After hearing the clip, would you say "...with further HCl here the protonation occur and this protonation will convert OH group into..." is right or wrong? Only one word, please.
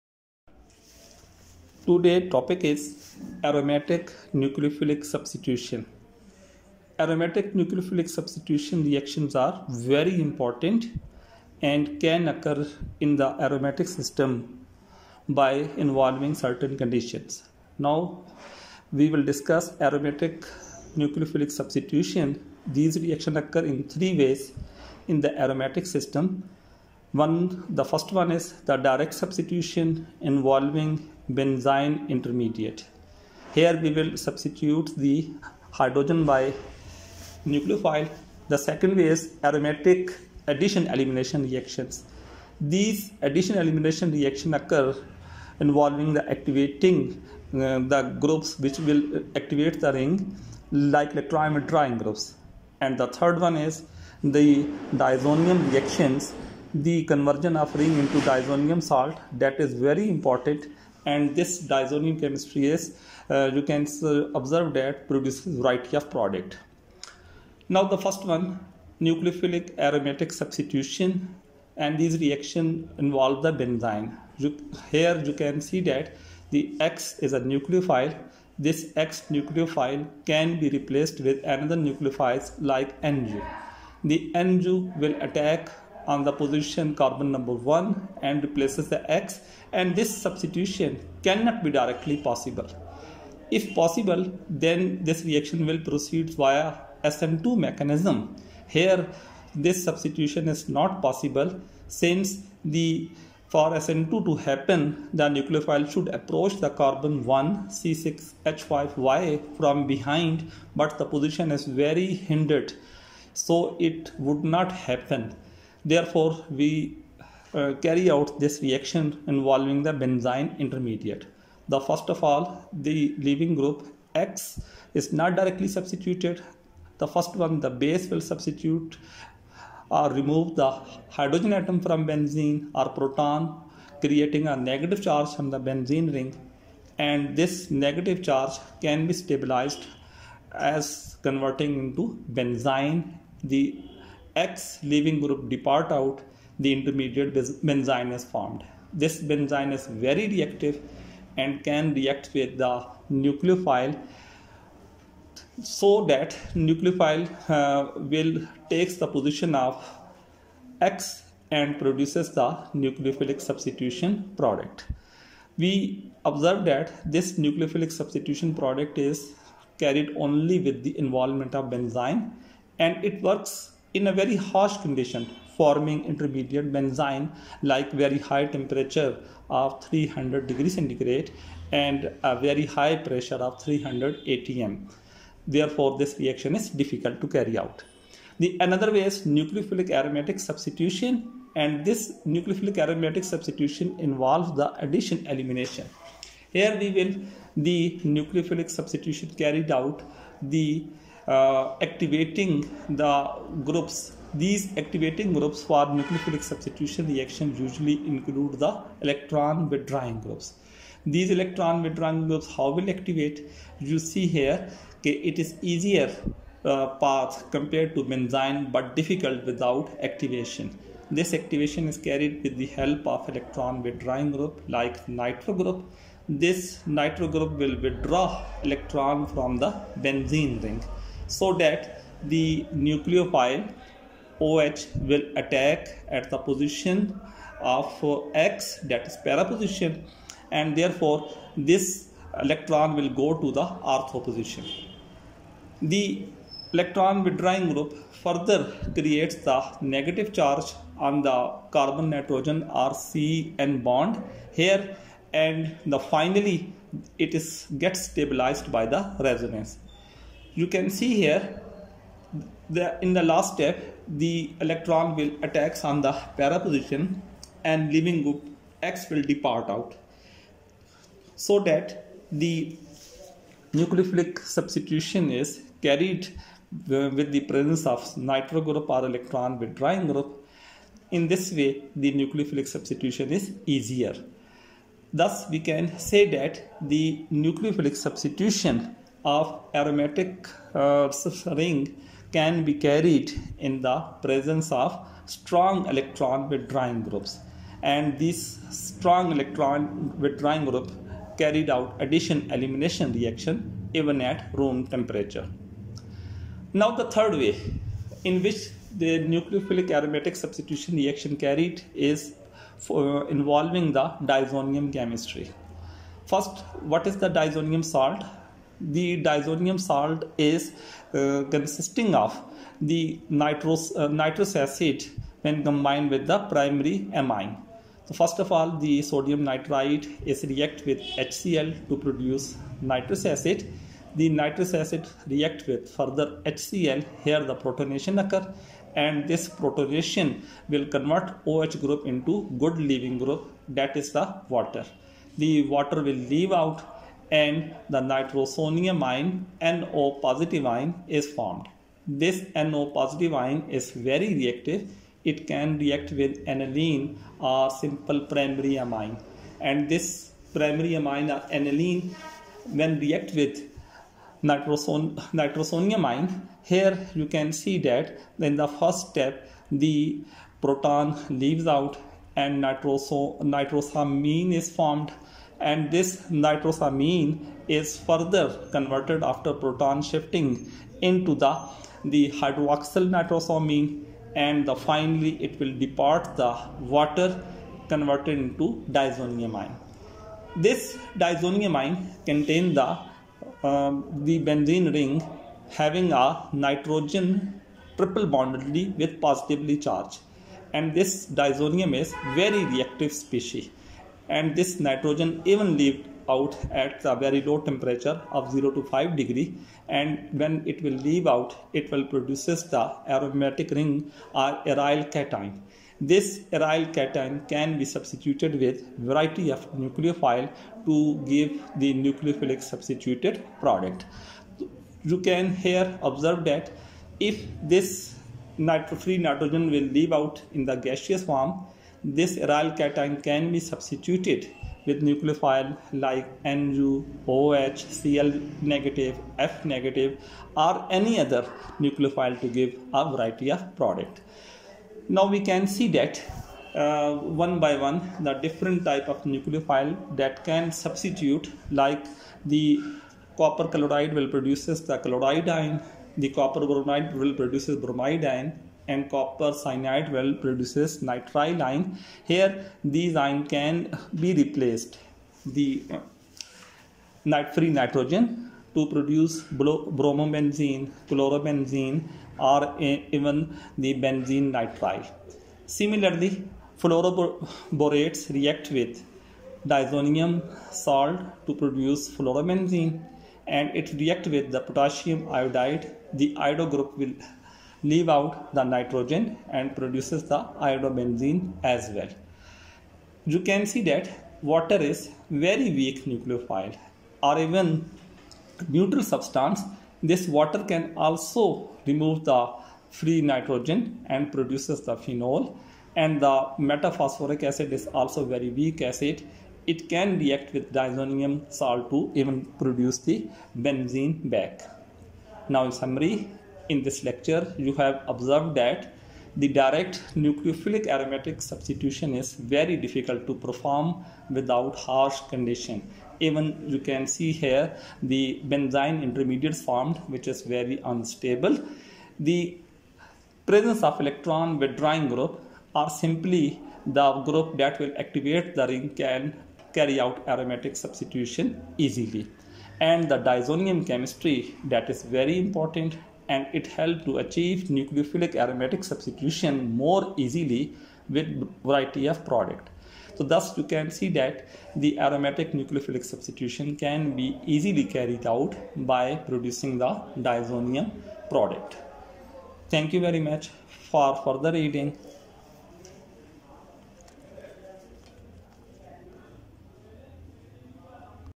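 right.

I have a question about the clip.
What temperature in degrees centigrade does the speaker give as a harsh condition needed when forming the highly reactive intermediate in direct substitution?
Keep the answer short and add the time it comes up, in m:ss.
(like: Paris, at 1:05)
300, at 2:59.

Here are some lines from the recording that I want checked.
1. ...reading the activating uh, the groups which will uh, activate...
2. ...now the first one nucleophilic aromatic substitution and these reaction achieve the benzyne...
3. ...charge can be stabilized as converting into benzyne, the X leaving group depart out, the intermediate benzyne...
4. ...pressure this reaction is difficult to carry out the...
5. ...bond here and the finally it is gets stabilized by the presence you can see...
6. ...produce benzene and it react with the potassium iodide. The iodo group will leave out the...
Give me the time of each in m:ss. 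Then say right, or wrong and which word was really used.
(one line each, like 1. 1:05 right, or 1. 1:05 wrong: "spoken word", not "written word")
1. 0:45 wrong: "involving", not "reading"
2. 1:07 wrong: "involve", not "achieve"
3. 2:18 right
4. 3:05 wrong: "therefore", not "pressure"
5. 4:13 wrong: "resonance", not "presence"
6. 8:01 wrong: "fluorobenzene", not "benzene".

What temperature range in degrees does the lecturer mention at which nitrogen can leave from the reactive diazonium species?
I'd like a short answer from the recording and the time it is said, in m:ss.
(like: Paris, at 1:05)
0 to 5 degrees, at 6:48.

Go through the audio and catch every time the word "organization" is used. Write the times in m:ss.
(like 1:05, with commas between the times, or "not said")
not said.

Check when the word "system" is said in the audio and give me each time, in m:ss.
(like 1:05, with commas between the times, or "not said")
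0:13, 0:25.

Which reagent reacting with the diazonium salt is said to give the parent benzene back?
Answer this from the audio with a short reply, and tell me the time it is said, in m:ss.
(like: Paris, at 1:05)
Metaphosphoric acid, at 8:26.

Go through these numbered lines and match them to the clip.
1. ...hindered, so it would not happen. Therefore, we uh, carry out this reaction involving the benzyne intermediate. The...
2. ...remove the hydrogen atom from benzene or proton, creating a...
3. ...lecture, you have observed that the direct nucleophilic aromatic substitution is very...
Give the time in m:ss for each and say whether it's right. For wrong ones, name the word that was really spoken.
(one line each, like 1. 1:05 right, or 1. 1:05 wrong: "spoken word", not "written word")
1. 1:52 right
2. 2:10 right
3. 8:37 right.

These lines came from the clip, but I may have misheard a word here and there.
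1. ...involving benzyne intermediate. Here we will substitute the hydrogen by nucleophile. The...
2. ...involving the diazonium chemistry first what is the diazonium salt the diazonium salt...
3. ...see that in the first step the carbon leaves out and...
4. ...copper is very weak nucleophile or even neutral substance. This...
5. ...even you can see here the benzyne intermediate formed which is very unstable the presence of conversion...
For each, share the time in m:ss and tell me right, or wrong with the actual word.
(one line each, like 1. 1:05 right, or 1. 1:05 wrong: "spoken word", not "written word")
1. 0:30 right
2. 5:13 right
3. 6:07 wrong: "proton", not "carbon"
4. 8:14 wrong: "water", not "copper"
5. 8:46 wrong: "electron", not "conversion".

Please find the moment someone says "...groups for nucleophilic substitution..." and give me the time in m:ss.
3:25.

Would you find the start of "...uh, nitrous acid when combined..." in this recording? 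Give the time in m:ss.
5:23.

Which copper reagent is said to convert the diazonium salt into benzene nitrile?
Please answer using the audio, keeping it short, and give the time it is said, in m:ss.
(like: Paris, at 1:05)
Copper cyanide, at 7:39.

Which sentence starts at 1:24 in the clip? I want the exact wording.
The NU will attack on the position carbon number 1 and replaces the X and this substitution cannot be directly possible.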